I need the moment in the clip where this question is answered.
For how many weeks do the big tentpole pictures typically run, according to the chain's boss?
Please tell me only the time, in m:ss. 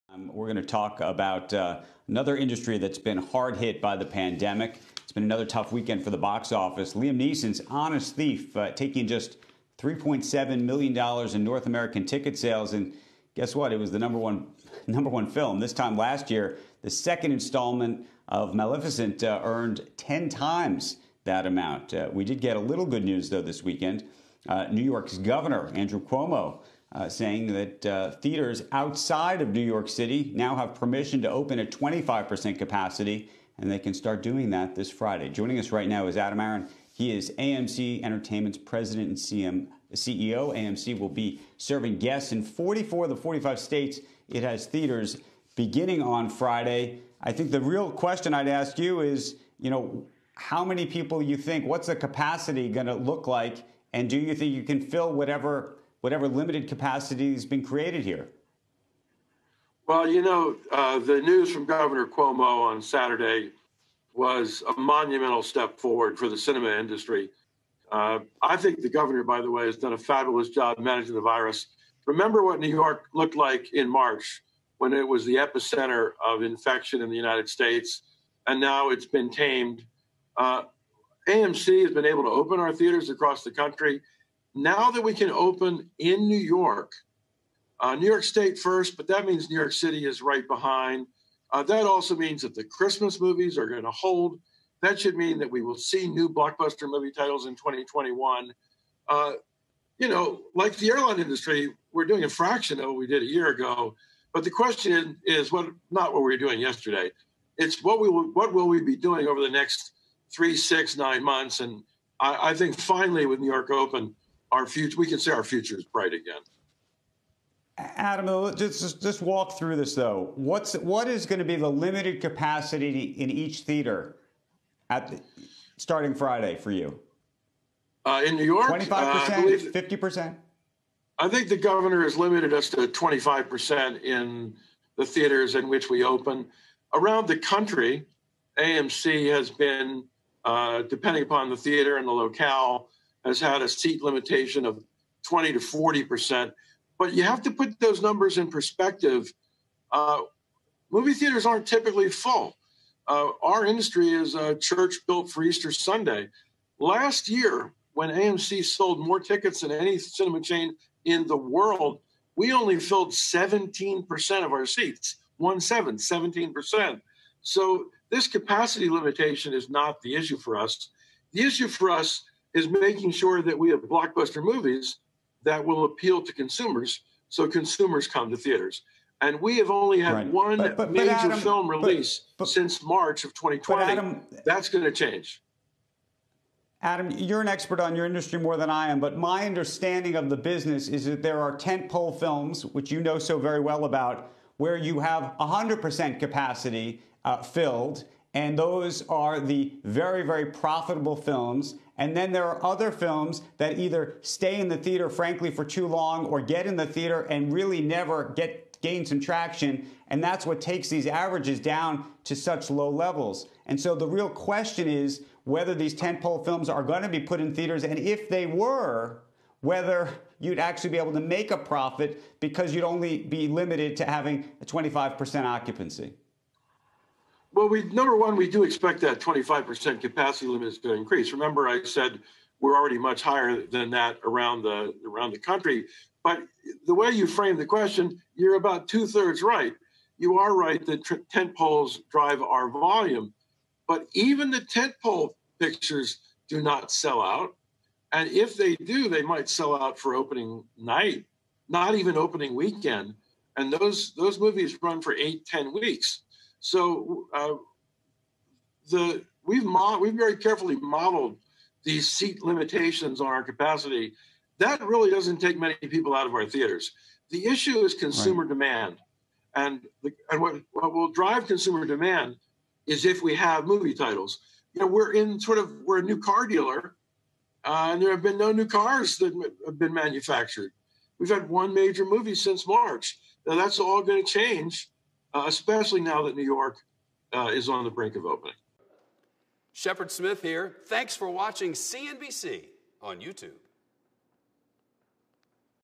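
4:15.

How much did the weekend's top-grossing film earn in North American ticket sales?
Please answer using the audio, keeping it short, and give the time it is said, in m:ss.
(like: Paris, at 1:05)
$3.7 million, at 0:09.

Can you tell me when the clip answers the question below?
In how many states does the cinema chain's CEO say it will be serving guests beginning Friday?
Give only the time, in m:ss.
0:42.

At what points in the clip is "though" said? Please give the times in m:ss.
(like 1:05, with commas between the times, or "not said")
0:23, 1:59.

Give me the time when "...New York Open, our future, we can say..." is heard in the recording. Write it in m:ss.
1:53.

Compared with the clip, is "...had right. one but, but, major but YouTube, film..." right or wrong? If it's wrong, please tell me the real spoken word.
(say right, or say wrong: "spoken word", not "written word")
wrong: "Adam", not "YouTube".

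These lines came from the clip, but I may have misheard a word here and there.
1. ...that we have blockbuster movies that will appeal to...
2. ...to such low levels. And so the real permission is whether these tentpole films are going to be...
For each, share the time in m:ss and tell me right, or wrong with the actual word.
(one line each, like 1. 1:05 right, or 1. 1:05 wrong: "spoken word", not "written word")
1. 2:53 right
2. 3:32 wrong: "question", not "permission".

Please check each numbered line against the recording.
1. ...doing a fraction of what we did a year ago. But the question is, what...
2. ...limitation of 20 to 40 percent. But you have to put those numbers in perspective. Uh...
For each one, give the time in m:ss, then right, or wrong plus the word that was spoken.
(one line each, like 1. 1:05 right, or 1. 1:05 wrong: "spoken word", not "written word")
1. 1:42 right
2. 2:24 right.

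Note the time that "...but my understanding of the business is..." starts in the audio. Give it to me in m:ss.
3:08.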